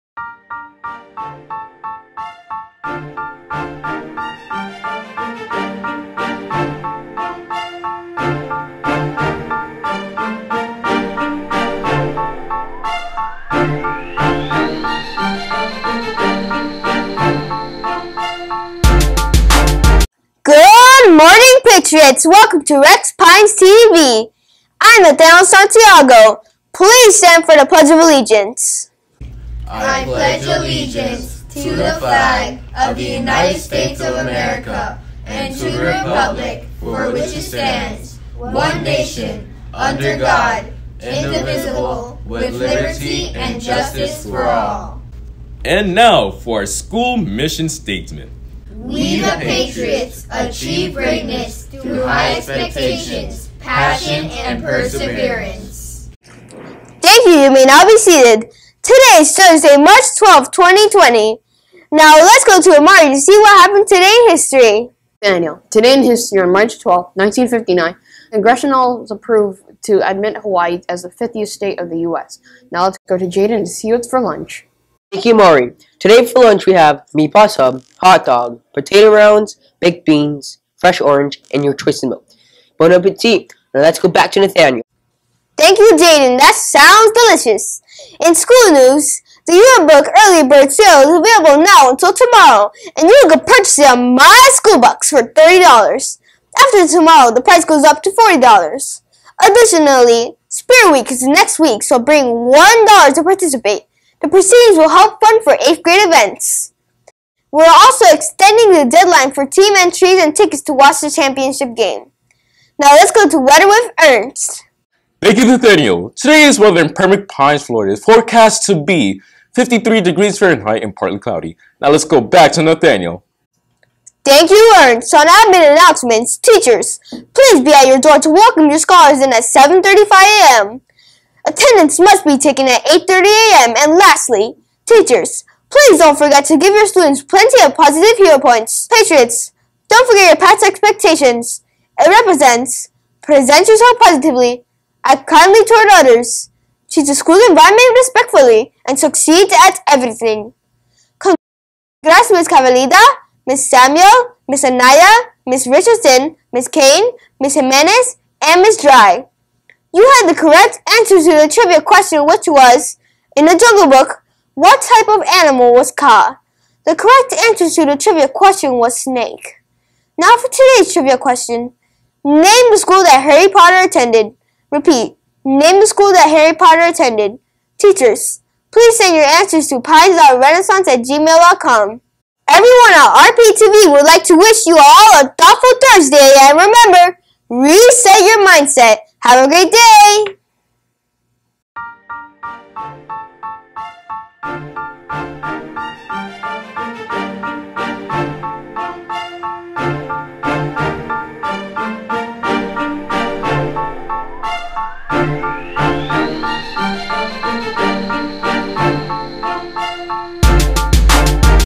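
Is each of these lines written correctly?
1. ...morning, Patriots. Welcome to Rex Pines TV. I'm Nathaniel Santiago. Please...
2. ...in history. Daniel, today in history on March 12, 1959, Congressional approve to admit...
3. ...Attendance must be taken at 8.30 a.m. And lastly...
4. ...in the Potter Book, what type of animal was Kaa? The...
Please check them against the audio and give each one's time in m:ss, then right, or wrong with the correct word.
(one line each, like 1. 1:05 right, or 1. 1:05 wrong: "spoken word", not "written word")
1. 0:21 right
2. 1:04 right
3. 2:11 right
4. 2:43 wrong: "Jungle", not "Potter".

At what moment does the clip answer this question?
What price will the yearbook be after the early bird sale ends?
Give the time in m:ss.
1:38.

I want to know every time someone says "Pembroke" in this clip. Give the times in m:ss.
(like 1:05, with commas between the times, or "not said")
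1:56.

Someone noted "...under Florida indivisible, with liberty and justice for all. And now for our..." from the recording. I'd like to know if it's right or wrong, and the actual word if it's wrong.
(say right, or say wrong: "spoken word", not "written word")
wrong: "God", not "Florida".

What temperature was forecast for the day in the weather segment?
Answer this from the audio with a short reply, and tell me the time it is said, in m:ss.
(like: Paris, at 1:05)
53 degrees Fahrenheit, at 1:59.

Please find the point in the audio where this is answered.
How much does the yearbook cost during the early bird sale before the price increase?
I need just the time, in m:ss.
1:35.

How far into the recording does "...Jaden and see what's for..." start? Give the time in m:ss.
1:13.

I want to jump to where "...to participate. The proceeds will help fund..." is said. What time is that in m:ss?
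1:43.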